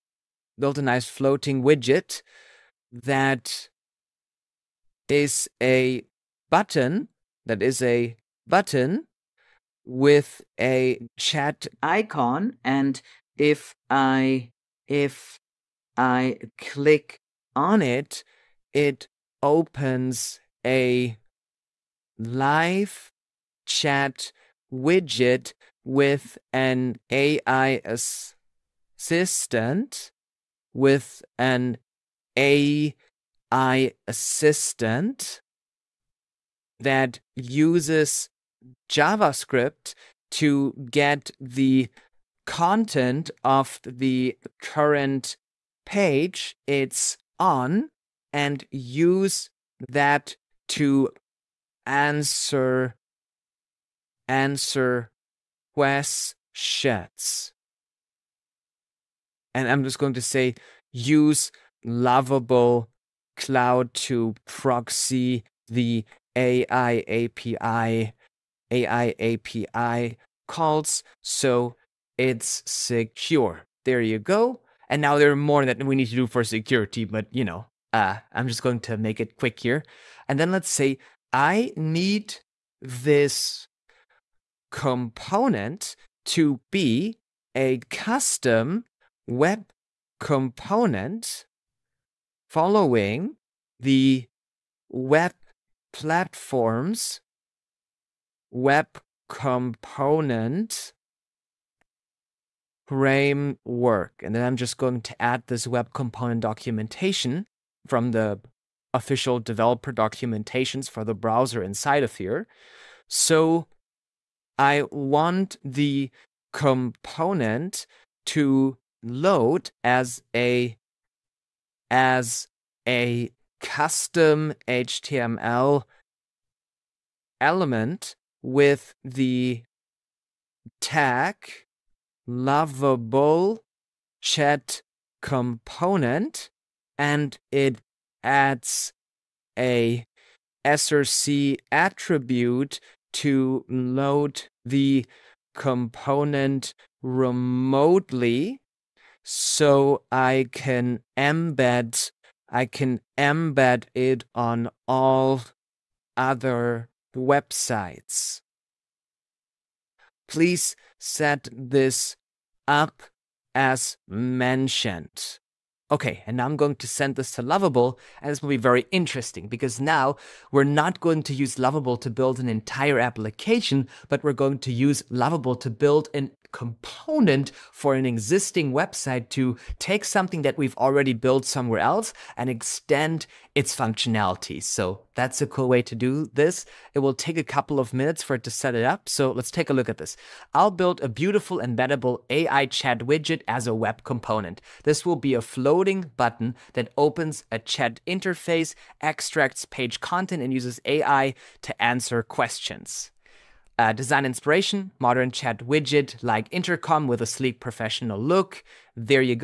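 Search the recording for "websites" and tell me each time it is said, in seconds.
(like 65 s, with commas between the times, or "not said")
157 s, 178 s.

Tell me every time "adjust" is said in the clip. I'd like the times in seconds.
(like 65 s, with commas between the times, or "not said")
not said.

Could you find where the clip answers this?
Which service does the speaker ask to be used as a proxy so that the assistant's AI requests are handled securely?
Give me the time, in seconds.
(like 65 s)
61 s.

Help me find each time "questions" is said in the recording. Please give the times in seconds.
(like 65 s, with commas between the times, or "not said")
55 s, 202 s.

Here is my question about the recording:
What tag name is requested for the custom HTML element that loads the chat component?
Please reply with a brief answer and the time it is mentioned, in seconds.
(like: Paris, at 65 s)
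lovable chat component, at 132 s.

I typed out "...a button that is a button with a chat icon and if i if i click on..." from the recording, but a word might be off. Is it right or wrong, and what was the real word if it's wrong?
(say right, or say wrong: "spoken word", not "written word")
right.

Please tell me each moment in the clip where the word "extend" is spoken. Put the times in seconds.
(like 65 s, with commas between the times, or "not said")
182 s.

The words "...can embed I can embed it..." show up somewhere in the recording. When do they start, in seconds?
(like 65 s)
150 s.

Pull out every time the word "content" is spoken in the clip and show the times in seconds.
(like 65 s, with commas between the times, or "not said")
42 s, 199 s.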